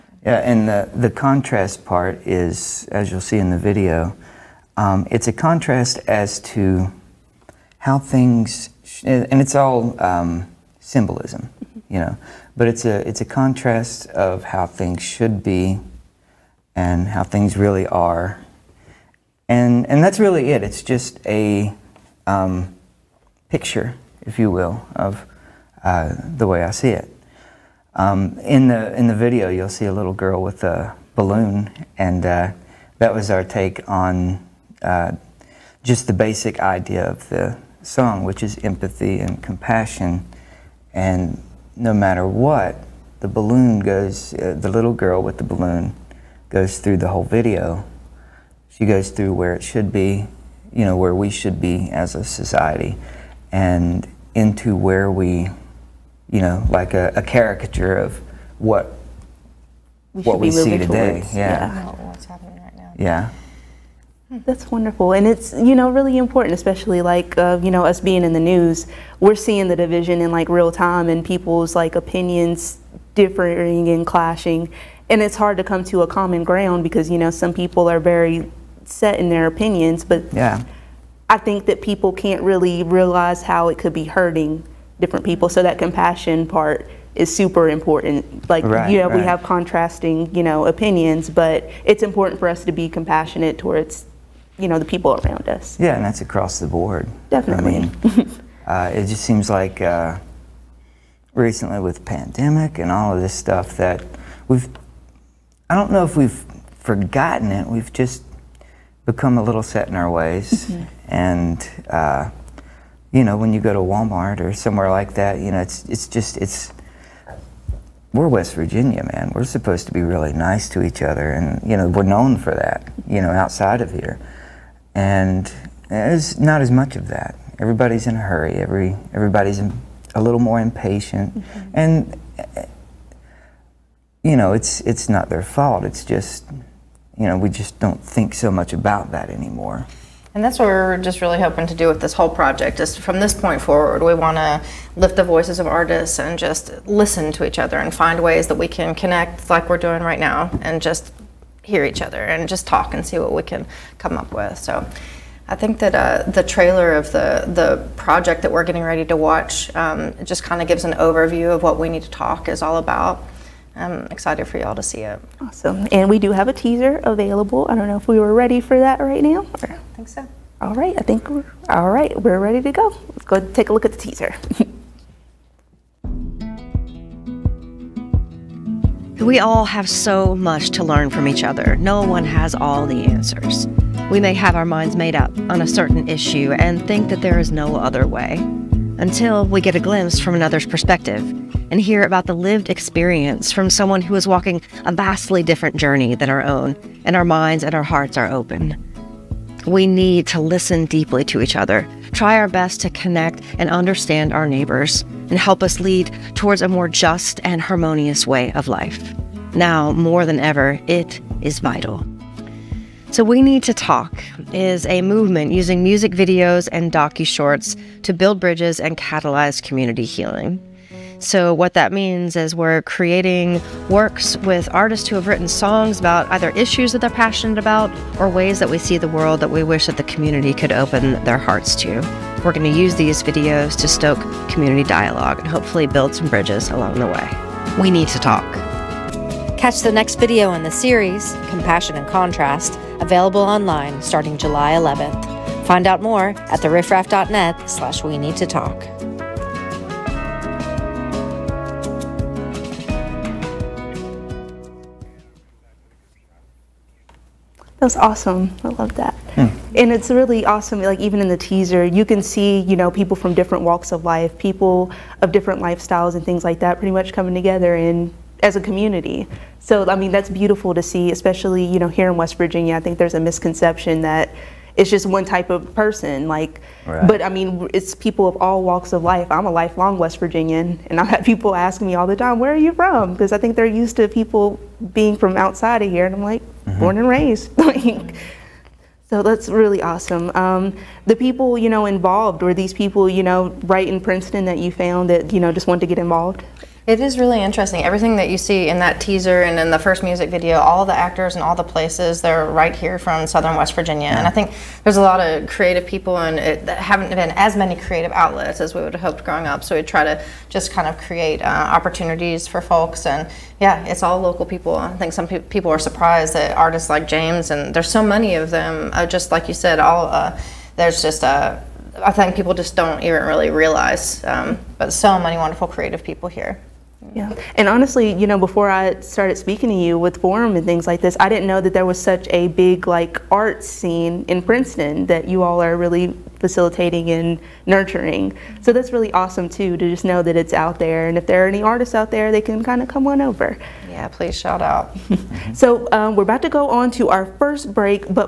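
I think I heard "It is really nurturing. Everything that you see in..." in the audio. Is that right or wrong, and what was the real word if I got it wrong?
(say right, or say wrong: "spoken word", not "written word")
wrong: "interesting", not "nurturing".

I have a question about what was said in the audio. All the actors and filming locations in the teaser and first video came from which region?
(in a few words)
southern West Virginia.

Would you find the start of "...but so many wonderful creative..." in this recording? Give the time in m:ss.
5:24.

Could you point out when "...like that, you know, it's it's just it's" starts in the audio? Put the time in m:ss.
1:54.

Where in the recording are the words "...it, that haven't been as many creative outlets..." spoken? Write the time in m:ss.
5:06.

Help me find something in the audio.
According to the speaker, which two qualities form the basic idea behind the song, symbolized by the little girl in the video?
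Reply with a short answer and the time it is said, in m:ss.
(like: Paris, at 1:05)
empathy and compassion, at 0:38.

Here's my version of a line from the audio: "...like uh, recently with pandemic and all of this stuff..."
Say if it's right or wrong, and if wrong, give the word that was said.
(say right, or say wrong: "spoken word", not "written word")
right.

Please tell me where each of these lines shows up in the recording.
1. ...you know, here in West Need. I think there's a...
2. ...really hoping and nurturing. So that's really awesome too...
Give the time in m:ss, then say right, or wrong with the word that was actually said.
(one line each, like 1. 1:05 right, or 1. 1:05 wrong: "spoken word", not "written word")
1. 4:31 wrong: "Virginia", not "Need"
2. 5:35 wrong: "facilitating", not "hoping".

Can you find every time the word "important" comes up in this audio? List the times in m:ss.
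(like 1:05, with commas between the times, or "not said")
1:06, 1:27, 1:32.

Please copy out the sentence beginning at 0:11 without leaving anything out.
you know, but it's a, it's a contrast of how things should be and how things really are.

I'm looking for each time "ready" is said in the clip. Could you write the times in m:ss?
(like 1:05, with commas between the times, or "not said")
2:38, 2:48, 2:52.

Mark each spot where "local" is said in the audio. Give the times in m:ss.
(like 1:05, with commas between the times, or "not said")
5:14.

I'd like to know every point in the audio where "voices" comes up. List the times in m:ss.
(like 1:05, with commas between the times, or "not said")
2:25.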